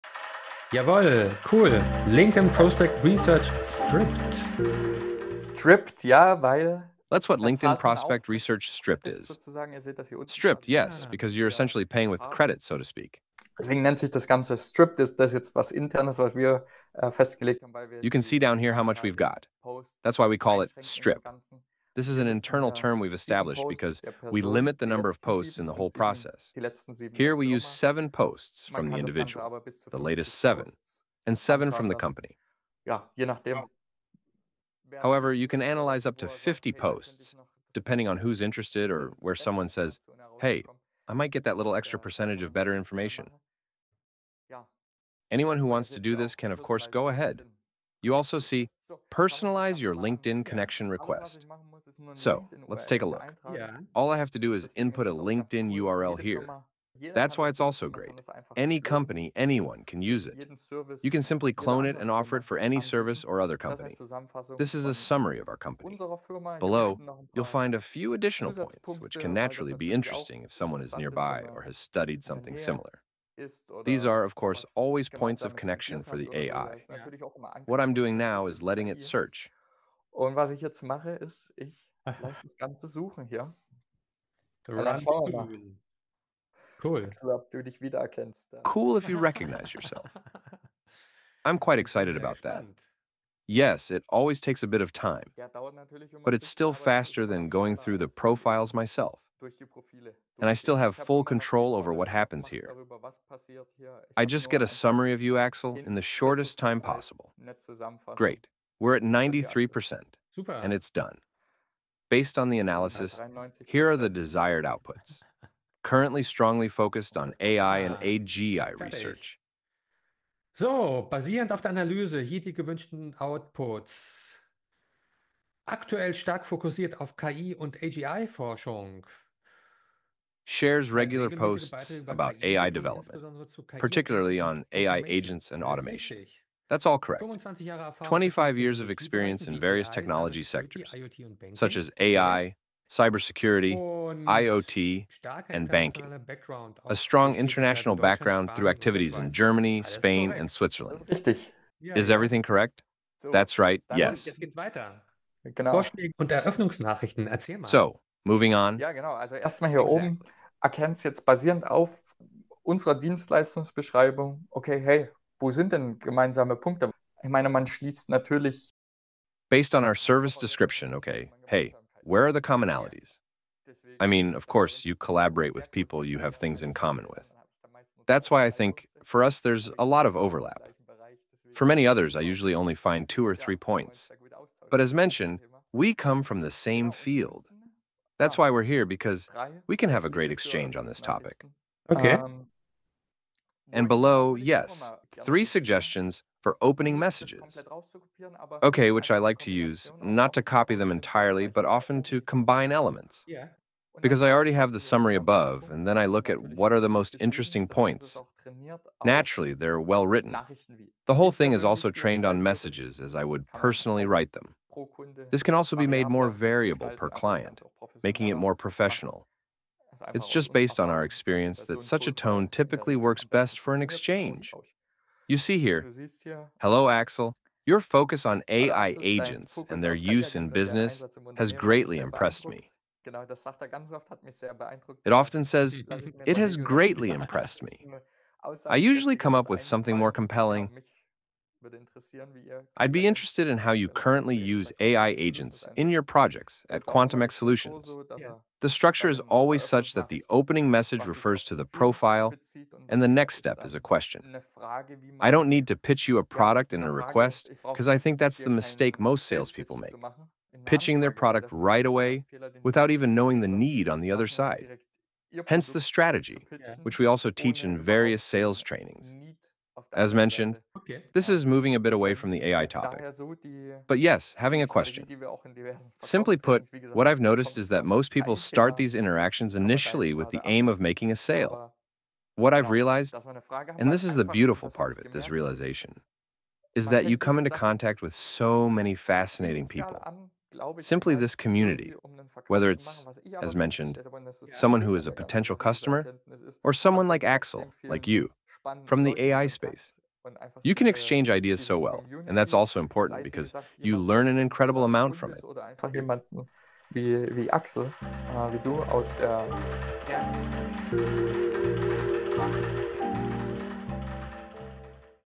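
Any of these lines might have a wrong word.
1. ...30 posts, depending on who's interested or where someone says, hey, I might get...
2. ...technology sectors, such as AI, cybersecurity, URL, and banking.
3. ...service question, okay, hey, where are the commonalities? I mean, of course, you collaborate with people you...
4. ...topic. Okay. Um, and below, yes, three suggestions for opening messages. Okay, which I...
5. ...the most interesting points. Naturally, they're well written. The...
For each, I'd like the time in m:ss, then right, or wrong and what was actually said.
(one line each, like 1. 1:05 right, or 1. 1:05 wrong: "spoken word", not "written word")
1. 0:36 wrong: "50", not "30"
2. 2:19 wrong: "IoT", not "URL"
3. 2:49 wrong: "description", not "question"
4. 3:11 right
5. 3:26 right.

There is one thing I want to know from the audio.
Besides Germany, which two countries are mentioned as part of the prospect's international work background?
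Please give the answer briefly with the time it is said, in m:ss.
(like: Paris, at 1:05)
Spain and Switzerland, at 2:29.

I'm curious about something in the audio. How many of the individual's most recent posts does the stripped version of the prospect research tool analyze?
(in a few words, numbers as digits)
7.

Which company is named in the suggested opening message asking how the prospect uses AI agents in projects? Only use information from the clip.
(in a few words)
QuantumX Solutions.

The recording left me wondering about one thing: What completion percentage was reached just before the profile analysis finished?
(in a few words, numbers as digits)
93%.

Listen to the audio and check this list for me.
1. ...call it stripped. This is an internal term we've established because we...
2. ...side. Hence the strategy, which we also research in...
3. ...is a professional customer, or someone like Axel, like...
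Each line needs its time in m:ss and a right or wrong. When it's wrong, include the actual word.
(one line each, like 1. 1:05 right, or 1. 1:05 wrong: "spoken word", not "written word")
1. 0:20 right
2. 4:24 wrong: "teach", not "research"
3. 4:54 wrong: "potential", not "professional".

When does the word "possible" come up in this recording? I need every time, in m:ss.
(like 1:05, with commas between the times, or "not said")
1:46.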